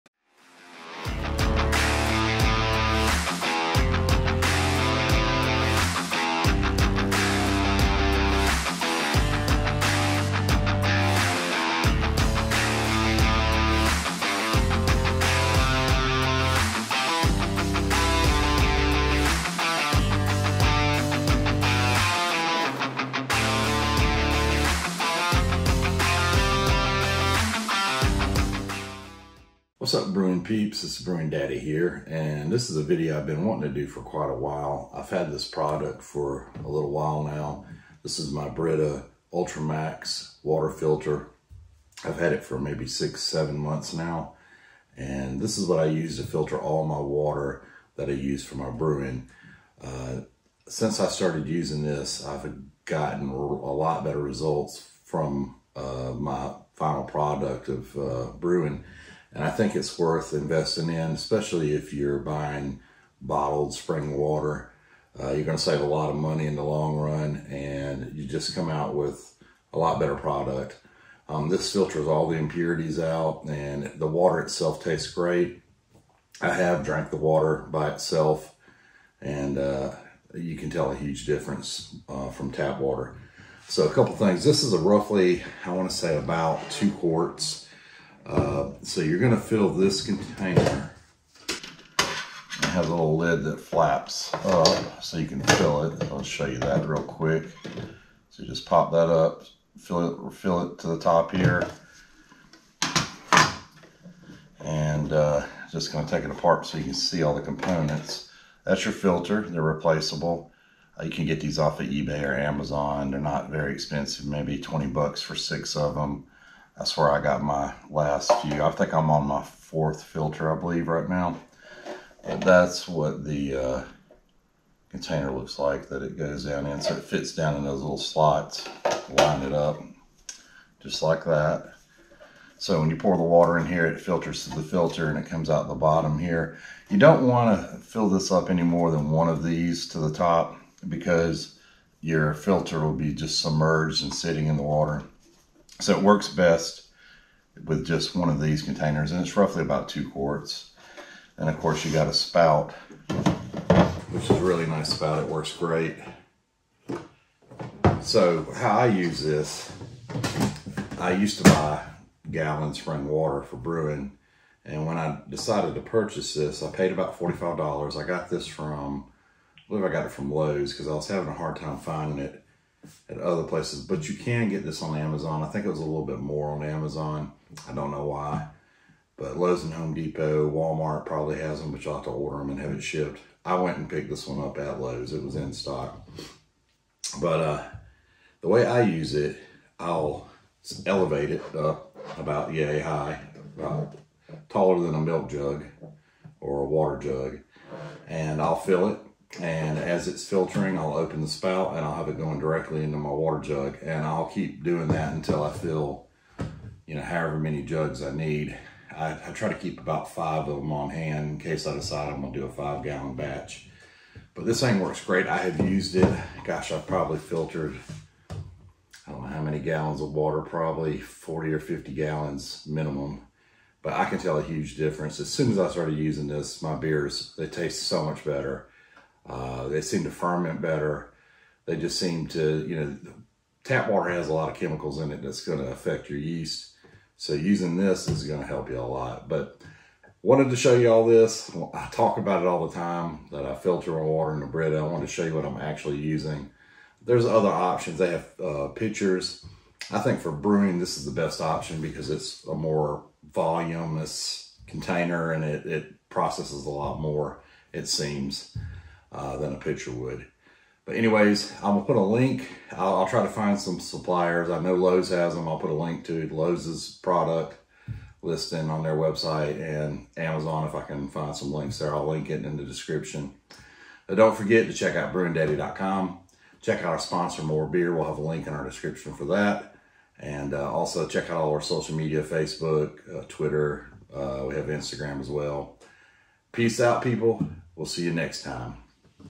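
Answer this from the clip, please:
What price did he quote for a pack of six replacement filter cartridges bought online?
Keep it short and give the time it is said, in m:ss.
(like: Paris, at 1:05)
$20, at 1:54.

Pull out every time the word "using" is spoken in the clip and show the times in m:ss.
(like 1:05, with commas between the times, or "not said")
0:51, 3:45, 3:57, 4:05.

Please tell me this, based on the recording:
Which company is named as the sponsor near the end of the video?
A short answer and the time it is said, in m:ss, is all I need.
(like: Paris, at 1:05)
More Beer, at 4:37.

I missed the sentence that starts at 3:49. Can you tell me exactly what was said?
Uh, they seem to ferment better.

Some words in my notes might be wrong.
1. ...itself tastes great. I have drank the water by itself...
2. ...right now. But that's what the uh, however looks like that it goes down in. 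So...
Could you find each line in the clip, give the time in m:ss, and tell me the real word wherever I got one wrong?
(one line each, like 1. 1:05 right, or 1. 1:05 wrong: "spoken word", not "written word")
1. 1:14 right
2. 2:00 wrong: "container", not "however".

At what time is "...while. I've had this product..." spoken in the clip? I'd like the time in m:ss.
0:34.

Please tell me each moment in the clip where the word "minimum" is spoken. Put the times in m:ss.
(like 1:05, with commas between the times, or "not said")
3:42.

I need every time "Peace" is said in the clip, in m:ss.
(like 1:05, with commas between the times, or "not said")
4:46.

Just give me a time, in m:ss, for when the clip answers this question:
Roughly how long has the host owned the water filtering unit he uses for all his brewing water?
0:42.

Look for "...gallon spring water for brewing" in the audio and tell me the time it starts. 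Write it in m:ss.
2:42.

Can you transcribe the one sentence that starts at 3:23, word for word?
And I'll keep doing that until I fill, you know, however many jugs I need.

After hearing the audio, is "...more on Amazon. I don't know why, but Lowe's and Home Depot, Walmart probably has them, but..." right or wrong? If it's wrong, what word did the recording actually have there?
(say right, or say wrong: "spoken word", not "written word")
right.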